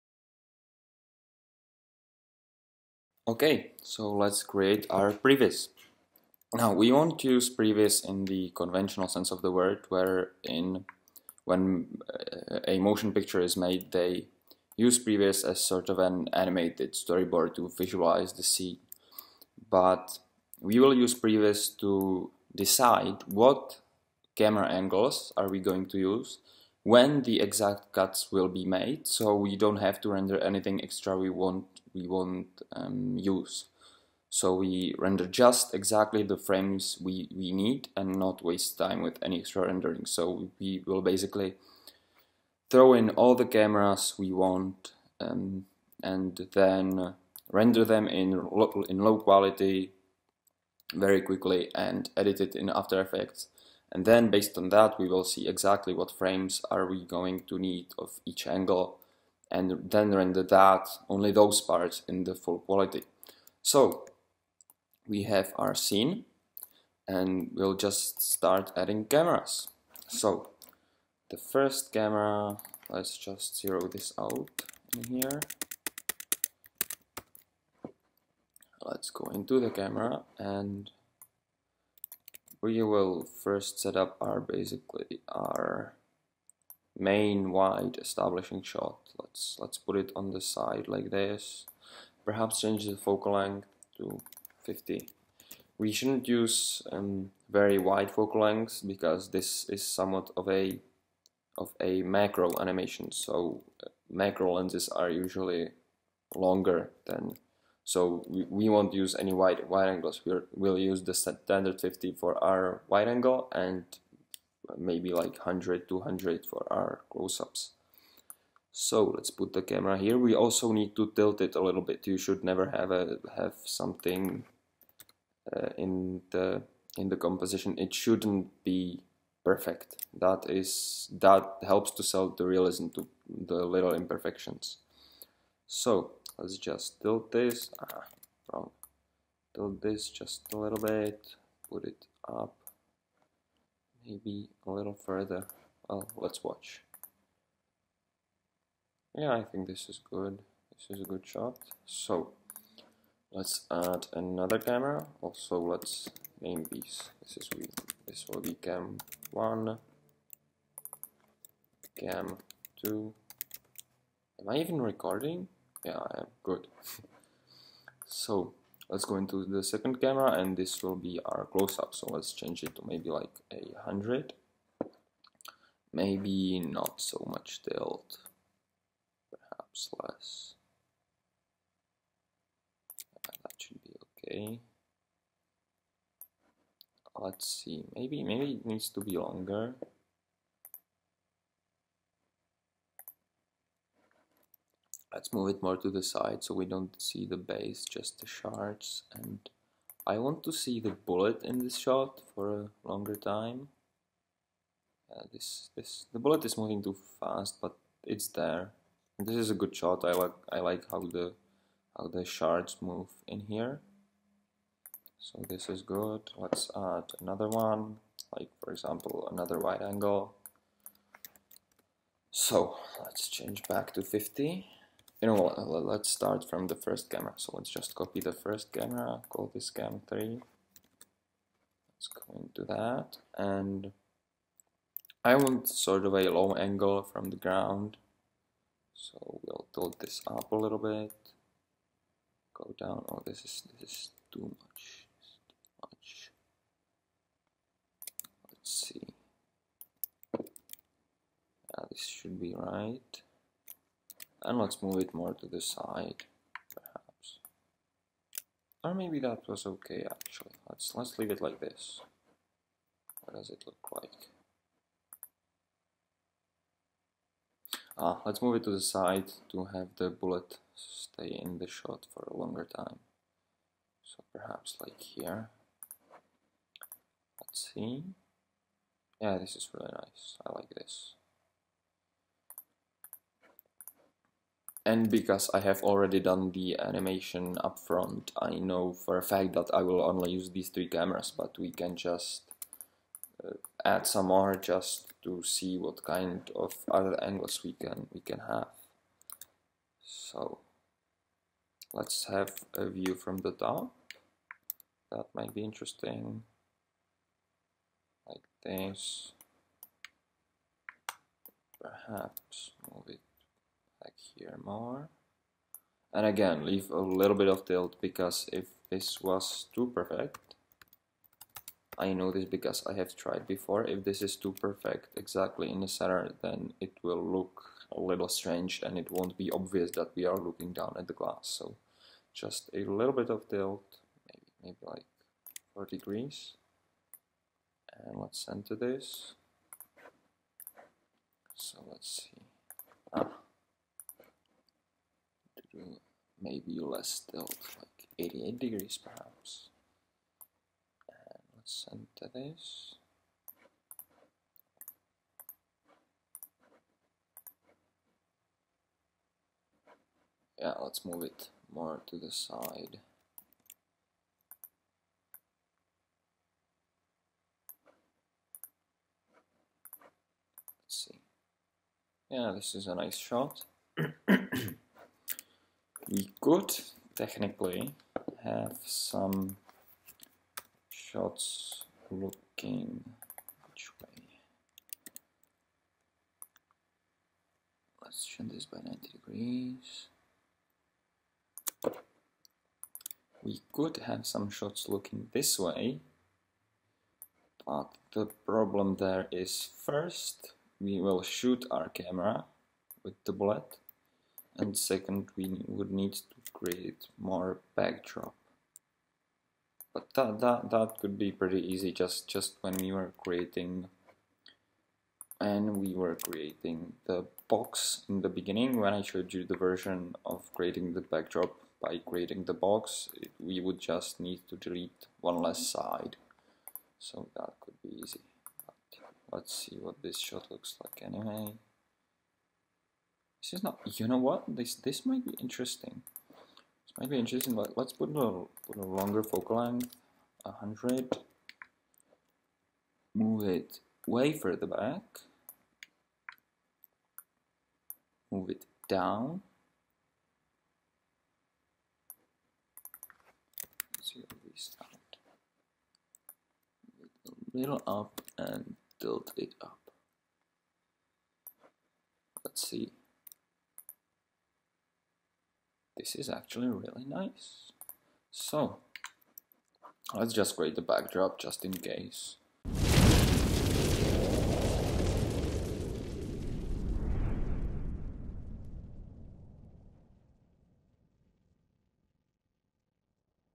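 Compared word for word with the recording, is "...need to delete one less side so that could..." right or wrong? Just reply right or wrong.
right.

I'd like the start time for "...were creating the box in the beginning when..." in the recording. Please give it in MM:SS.
06:55.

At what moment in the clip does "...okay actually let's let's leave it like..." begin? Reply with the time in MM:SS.
04:19.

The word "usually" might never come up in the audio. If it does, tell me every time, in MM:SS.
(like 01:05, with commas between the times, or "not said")
01:45.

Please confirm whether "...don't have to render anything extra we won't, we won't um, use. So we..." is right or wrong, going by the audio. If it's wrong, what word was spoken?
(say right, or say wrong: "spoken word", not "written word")
right.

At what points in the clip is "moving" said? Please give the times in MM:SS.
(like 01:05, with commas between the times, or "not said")
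03:26.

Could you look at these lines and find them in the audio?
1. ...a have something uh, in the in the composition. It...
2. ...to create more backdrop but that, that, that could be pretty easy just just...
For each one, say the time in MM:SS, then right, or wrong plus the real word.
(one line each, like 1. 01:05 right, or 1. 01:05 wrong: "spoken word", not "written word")
1. 02:02 right
2. 06:46 right.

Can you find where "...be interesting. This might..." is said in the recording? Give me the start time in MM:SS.
07:15.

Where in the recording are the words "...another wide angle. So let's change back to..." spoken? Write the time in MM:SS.
03:39.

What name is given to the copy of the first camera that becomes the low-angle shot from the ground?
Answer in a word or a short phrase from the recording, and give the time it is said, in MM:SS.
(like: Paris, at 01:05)
cam 3, at 03:49.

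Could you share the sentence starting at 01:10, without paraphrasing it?
So the first camera, let's just zero this out in here.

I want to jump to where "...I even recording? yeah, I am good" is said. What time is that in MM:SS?
02:44.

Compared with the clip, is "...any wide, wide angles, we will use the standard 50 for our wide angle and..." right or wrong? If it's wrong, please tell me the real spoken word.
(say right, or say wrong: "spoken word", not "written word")
right.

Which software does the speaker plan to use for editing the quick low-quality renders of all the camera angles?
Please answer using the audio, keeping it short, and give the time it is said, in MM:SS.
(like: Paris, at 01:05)
After Effects, at 00:52.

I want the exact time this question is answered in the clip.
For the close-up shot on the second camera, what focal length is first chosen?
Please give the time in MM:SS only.
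02:53.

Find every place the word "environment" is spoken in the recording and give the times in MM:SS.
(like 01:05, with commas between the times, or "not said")
not said.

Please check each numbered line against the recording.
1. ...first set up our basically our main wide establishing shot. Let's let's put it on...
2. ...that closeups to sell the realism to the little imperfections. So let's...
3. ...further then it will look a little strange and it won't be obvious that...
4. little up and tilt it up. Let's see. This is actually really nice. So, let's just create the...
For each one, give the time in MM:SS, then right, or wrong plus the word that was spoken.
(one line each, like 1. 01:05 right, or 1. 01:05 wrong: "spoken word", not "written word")
1. 01:23 right
2. 02:11 wrong: "helps", not "closeups"
3. 05:25 wrong: "center", not "further"
4. 07:37 right.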